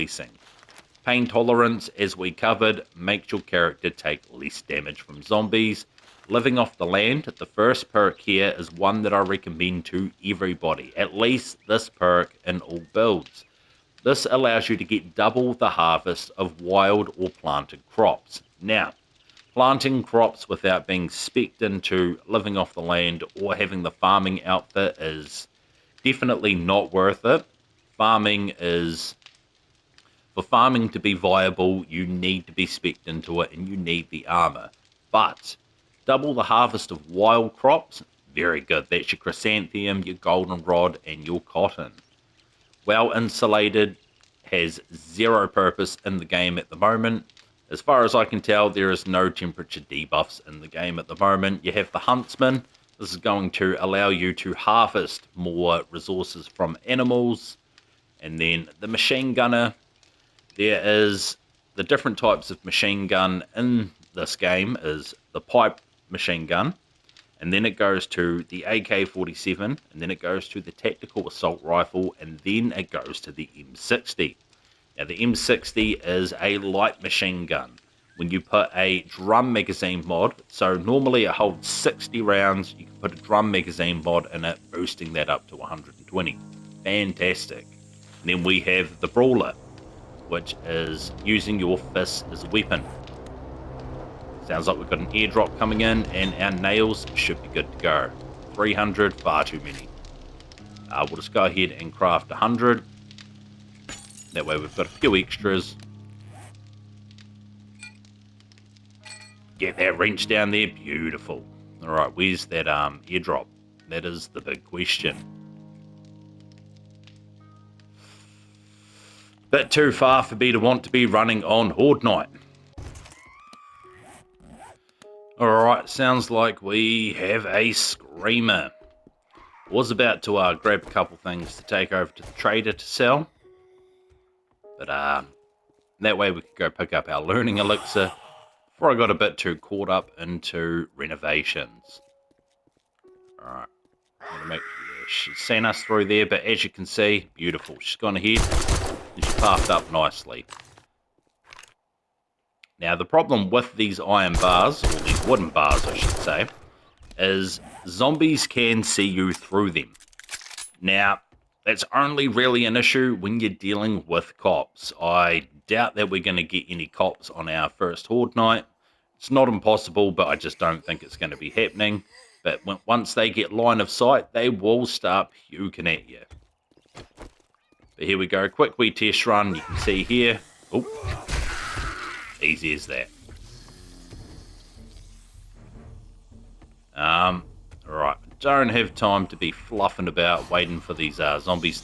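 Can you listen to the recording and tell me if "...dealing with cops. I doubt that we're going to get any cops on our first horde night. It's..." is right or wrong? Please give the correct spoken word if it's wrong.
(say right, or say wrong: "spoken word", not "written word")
right.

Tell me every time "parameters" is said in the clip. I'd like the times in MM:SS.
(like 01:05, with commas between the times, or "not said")
not said.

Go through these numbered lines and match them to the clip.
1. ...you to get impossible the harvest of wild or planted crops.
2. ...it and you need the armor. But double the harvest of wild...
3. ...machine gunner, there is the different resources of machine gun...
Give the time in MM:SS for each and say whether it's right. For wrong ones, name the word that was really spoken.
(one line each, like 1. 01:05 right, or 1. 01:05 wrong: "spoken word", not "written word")
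1. 00:14 wrong: "double", not "impossible"
2. 00:33 right
3. 00:58 wrong: "types", not "resources".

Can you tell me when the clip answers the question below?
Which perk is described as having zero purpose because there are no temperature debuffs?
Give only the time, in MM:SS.
00:42.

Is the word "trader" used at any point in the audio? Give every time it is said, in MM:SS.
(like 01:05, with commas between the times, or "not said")
02:12.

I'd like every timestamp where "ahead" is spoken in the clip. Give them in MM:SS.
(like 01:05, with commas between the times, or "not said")
01:41, 02:28.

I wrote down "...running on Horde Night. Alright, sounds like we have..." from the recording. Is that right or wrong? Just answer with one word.
right.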